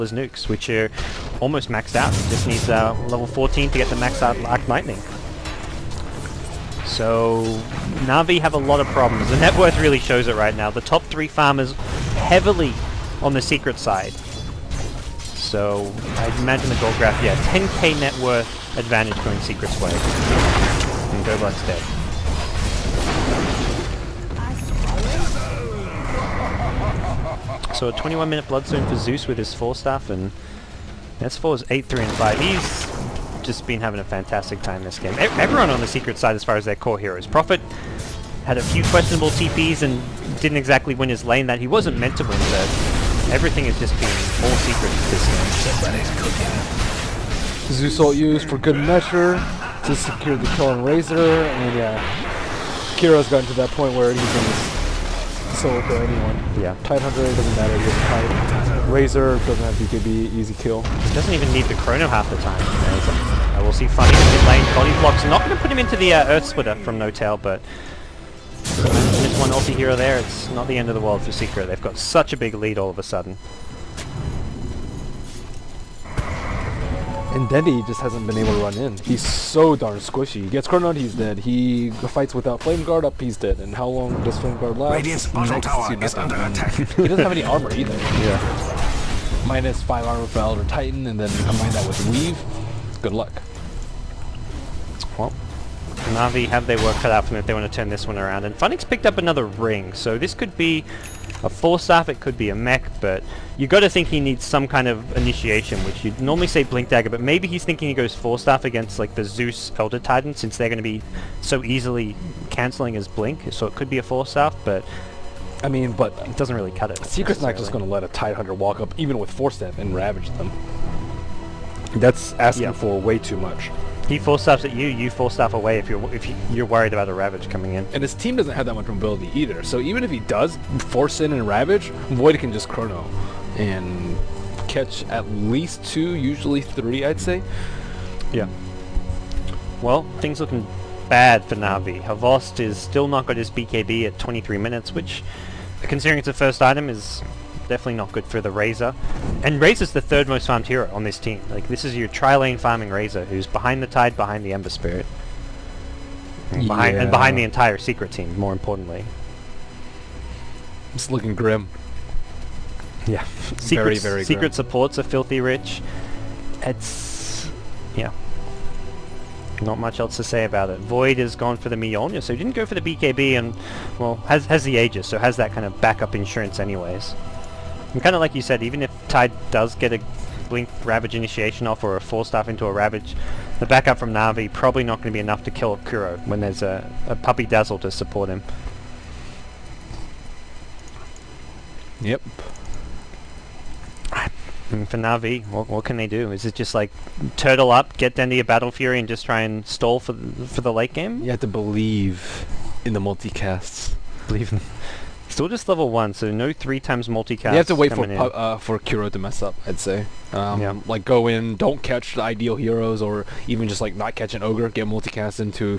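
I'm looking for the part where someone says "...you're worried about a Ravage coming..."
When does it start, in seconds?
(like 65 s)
126 s.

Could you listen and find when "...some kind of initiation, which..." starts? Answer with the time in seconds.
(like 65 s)
104 s.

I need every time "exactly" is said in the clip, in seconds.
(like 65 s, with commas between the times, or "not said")
40 s.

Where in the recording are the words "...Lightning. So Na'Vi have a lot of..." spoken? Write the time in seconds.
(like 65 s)
4 s.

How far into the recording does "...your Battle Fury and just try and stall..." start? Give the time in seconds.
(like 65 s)
198 s.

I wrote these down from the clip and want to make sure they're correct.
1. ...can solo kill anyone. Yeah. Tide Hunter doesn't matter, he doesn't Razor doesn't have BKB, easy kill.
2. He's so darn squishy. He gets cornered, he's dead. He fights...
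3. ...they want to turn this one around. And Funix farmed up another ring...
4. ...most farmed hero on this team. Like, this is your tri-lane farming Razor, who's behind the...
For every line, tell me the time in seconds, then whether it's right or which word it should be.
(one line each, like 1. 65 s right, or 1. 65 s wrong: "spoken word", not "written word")
1. 54 s right
2. 78 s right
3. 97 s wrong: "picked", not "farmed"
4. 150 s right.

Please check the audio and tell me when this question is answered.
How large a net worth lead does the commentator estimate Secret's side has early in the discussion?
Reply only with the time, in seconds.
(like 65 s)
17 s.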